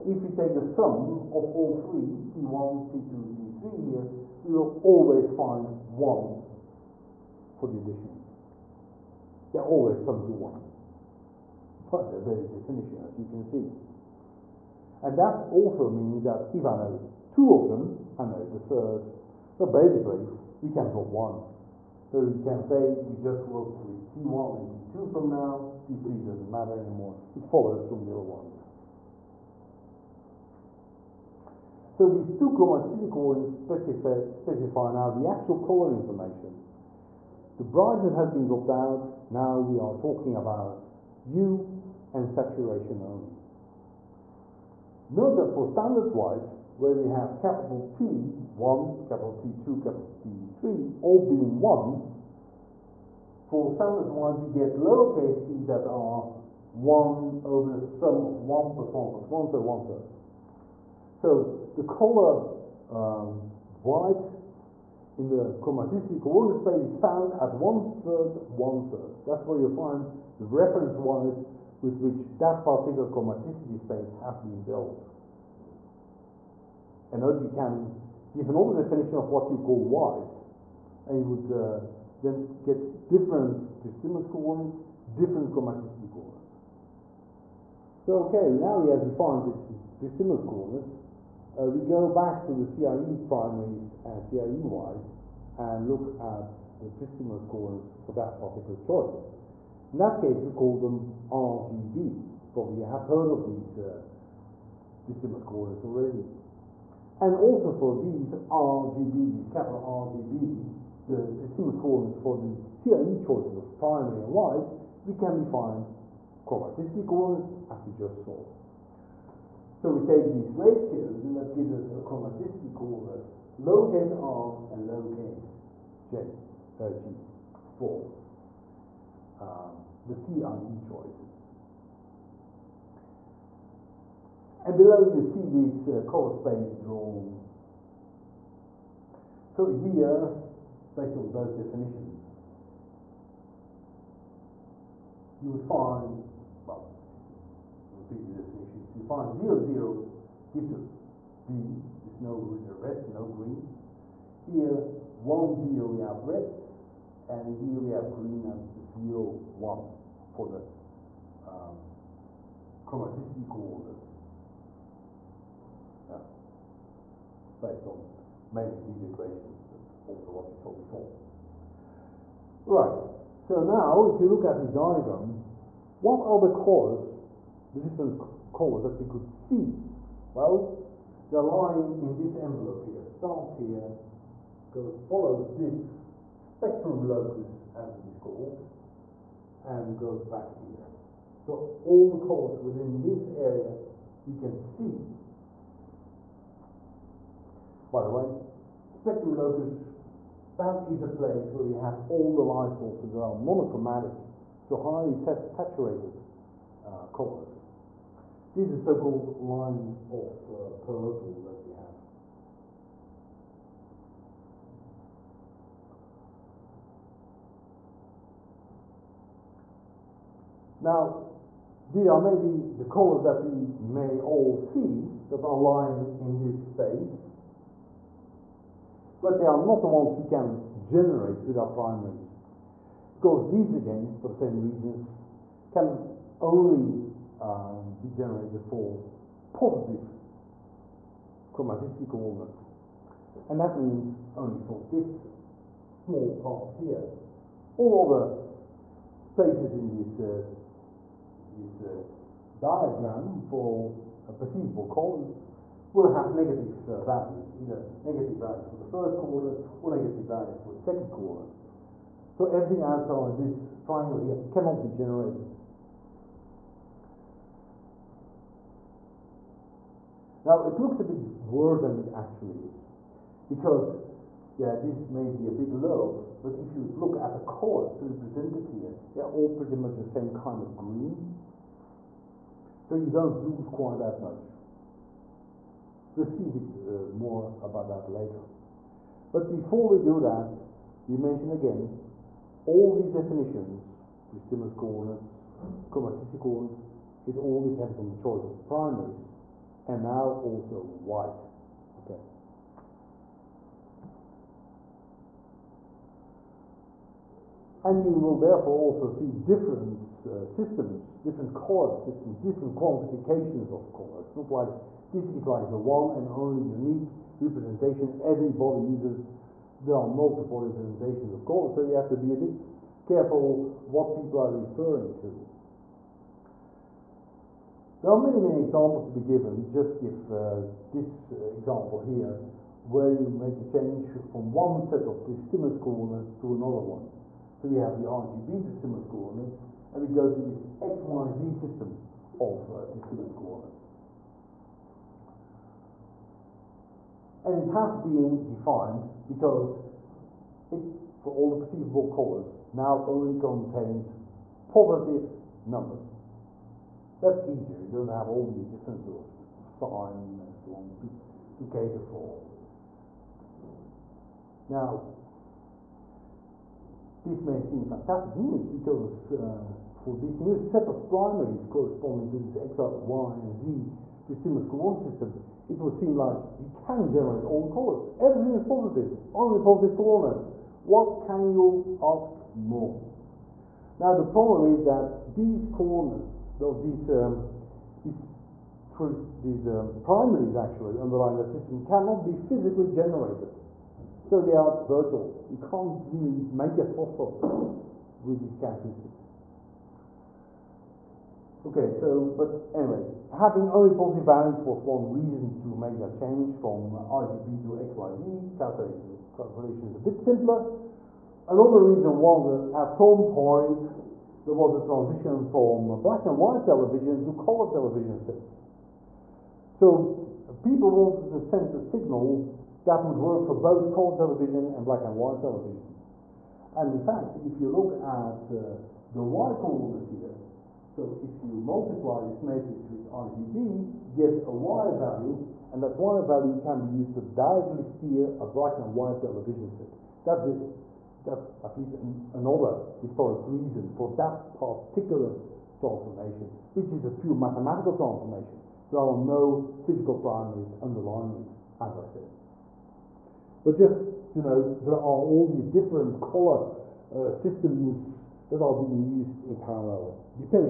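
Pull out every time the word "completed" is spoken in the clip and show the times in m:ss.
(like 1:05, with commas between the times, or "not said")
2:28.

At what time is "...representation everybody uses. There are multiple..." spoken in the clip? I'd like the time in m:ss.
5:17.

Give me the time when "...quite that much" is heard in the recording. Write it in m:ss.
4:43.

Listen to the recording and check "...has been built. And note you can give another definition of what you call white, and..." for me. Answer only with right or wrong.
right.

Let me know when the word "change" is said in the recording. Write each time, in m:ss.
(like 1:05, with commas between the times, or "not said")
5:33, 6:46.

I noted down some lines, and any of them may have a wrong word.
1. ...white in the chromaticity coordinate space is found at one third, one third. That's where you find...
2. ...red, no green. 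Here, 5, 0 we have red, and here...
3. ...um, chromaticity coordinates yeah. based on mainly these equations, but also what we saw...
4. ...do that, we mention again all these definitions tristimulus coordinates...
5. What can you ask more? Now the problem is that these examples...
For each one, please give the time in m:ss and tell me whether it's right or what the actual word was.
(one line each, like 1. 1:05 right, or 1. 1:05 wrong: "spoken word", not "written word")
1. 1:03 right
2. 2:32 wrong: "1", not "5"
3. 2:41 right
4. 4:50 right
5. 6:20 wrong: "coordinates", not "examples".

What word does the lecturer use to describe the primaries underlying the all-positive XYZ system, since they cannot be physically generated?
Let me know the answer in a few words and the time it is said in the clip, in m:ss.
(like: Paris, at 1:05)
virtual, at 6:34.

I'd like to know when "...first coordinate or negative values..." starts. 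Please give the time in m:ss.
4:18.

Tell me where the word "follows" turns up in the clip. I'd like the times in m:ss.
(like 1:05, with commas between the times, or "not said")
0:27, 3:05.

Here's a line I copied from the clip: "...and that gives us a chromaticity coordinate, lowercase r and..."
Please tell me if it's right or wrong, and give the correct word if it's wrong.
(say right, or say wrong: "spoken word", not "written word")
right.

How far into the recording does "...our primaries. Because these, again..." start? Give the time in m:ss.
3:51.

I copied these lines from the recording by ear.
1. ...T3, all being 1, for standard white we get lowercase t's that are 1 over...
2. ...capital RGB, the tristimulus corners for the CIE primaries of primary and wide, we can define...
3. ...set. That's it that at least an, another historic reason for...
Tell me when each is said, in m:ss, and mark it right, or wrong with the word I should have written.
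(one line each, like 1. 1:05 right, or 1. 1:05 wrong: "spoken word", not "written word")
1. 0:50 right
2. 1:49 wrong: "choices", not "primaries"
3. 7:19 right.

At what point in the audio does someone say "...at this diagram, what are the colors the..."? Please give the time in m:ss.
2:54.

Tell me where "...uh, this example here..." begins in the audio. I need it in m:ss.
5:30.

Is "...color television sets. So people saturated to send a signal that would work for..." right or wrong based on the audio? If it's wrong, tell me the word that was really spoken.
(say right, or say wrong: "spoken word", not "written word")
wrong: "wanted", not "saturated".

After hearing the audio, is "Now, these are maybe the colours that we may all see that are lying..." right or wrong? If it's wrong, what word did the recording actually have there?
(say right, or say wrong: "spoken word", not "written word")
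right.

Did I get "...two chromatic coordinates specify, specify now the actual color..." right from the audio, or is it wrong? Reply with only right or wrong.
right.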